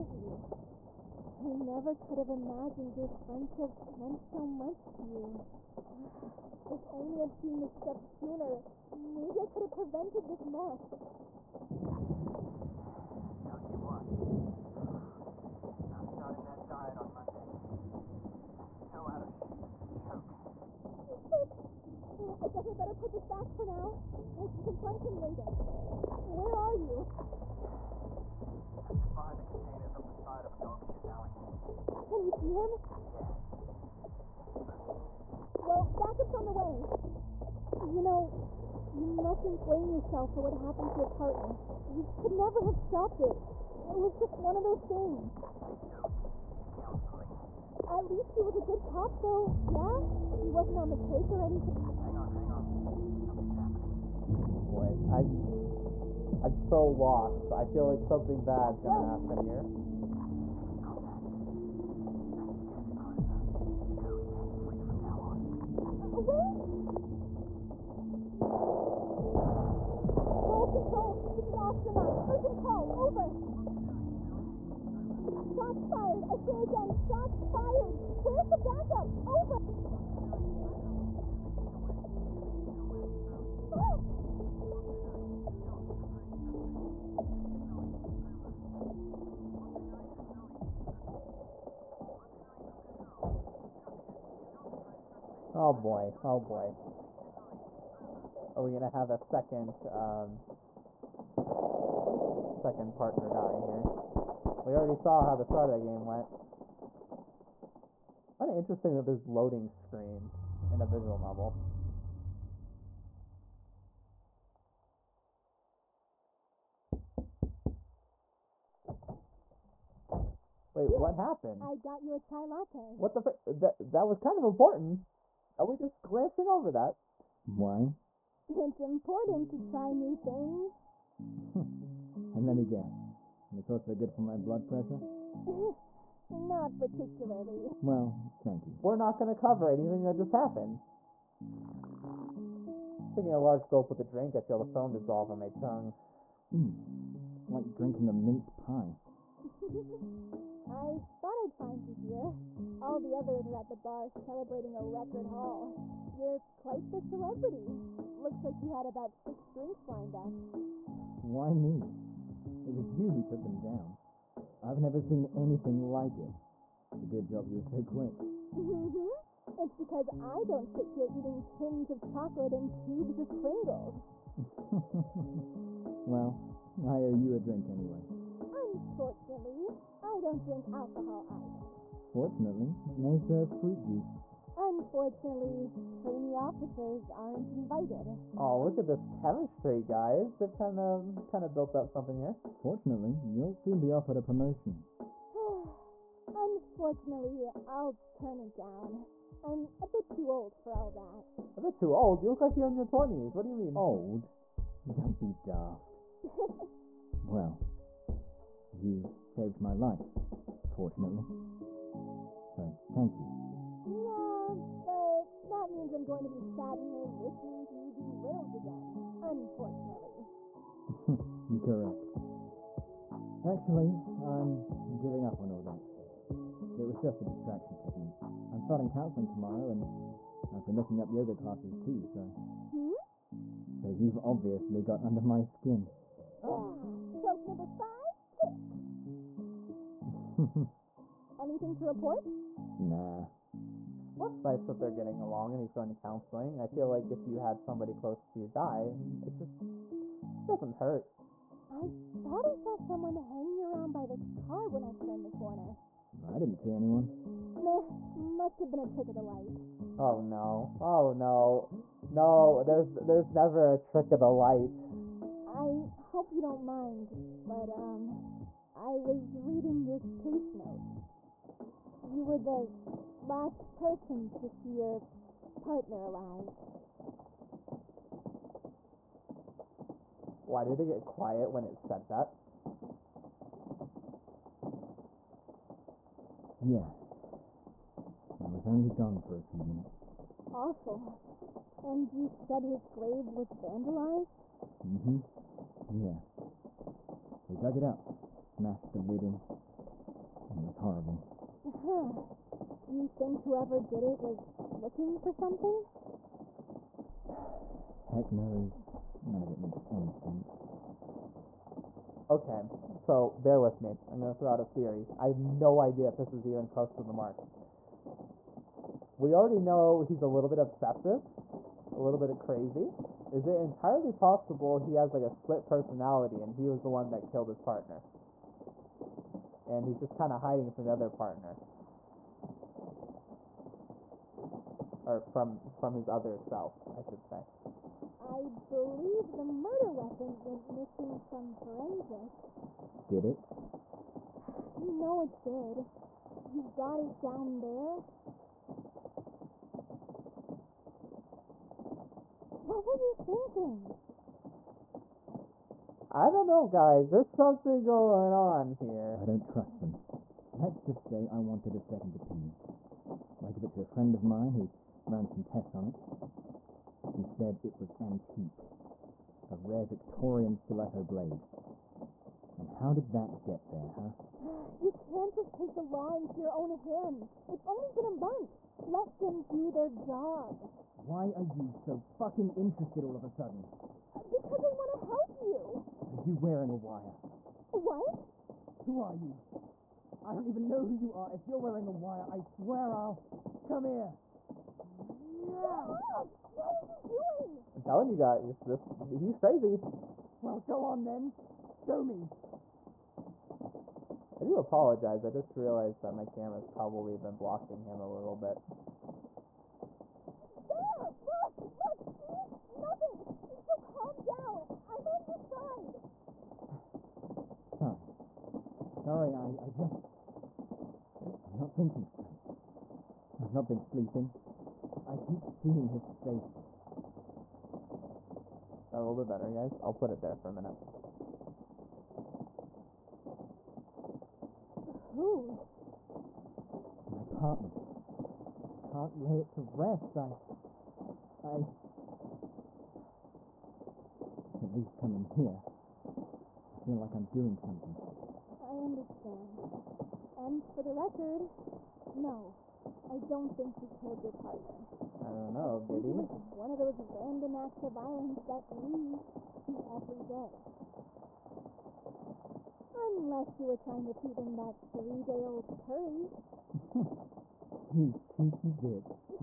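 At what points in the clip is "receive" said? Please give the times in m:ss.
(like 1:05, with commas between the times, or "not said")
not said.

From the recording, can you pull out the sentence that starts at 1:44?
We already saw how the start of that game went.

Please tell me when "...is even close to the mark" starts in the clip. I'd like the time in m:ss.
5:16.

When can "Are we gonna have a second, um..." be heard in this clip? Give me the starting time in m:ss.
1:38.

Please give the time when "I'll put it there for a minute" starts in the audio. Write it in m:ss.
7:09.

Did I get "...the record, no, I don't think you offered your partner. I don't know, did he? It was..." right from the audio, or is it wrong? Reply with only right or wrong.
wrong.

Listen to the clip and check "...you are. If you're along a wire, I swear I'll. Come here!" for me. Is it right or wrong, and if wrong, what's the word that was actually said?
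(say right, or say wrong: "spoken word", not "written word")
wrong: "wearing", not "along".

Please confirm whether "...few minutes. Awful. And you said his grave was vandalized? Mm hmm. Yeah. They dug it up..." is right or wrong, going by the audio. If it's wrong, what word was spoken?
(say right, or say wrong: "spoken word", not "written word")
right.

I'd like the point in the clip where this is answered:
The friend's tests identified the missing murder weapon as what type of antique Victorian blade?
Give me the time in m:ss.
6:10.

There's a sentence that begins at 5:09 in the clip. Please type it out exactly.
None of it makes any sense.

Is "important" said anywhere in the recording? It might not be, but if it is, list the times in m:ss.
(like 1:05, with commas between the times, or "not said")
2:04, 2:08.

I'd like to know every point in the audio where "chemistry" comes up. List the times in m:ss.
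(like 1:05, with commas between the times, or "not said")
3:09.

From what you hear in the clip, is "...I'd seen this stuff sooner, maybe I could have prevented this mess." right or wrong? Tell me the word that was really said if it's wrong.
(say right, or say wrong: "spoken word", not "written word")
right.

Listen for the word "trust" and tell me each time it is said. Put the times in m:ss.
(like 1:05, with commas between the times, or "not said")
5:59.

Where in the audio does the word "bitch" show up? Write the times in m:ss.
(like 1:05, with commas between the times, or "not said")
7:48.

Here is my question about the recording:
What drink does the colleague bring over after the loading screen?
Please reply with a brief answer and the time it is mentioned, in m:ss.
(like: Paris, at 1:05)
chai latte, at 2:02.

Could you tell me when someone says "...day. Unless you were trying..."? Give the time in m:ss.
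7:40.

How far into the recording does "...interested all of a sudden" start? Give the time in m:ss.
6:22.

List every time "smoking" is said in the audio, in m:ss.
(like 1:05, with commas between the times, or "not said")
0:34.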